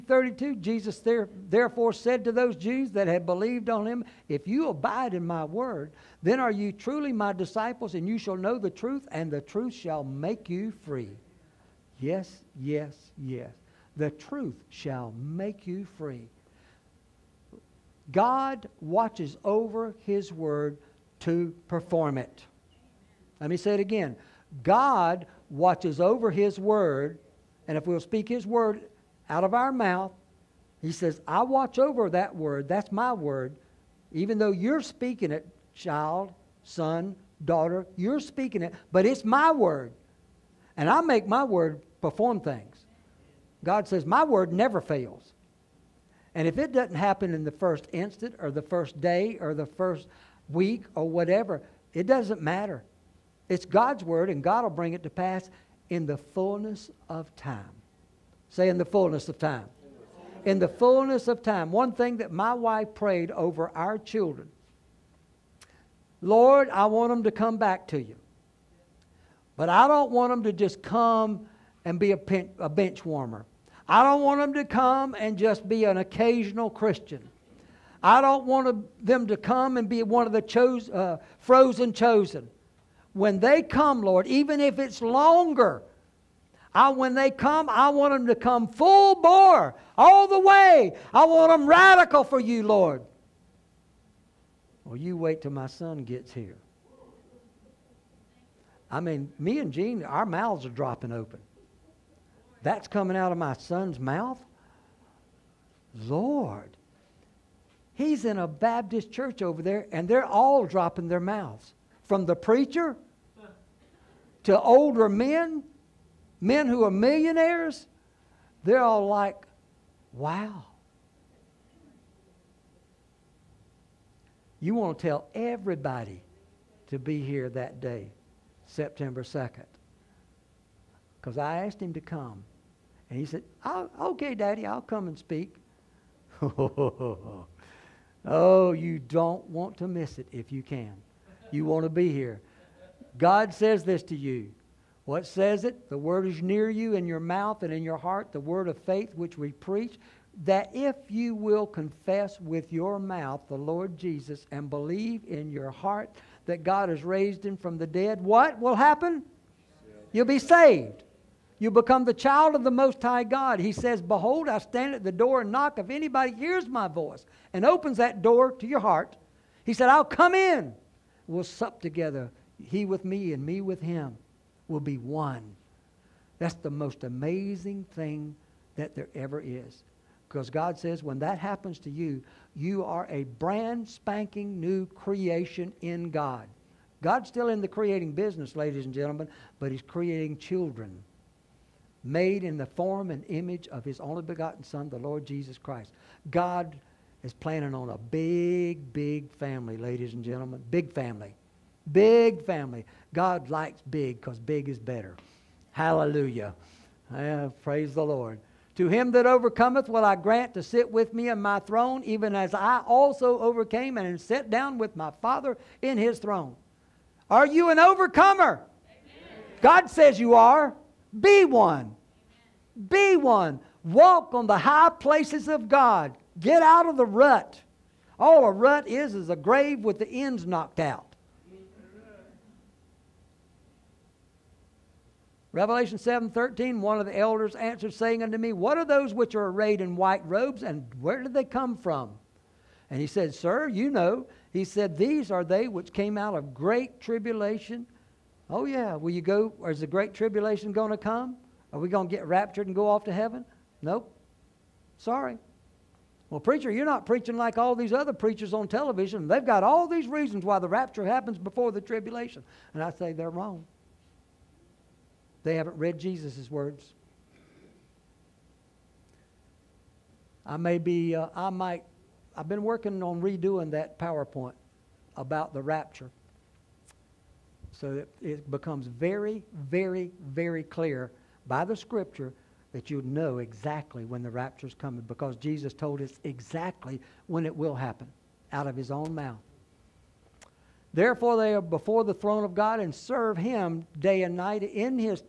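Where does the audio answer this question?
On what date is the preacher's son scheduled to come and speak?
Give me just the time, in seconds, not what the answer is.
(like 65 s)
128 s.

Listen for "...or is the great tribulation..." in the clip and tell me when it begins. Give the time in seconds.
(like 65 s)
249 s.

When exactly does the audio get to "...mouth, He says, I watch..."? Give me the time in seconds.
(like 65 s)
29 s.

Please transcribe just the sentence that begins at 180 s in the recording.
Because God says when that happens to you, you are a brand spanking new creation in God.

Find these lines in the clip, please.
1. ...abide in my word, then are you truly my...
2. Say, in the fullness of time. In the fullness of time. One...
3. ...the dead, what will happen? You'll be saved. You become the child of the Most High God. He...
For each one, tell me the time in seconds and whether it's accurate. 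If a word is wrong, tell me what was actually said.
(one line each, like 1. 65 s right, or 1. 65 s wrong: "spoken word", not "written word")
1. 4 s right
2. 58 s right
3. 157 s right.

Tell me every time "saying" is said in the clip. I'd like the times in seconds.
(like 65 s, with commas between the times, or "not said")
237 s.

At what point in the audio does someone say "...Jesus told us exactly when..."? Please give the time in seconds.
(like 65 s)
285 s.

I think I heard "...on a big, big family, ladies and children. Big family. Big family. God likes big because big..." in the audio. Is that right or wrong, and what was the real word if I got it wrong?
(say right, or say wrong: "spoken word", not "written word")
wrong: "gentlemen", not "children".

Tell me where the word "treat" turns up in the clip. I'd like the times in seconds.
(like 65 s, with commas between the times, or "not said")
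not said.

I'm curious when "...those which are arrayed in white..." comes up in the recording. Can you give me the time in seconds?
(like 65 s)
238 s.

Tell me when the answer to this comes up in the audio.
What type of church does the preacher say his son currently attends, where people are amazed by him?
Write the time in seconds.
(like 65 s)
108 s.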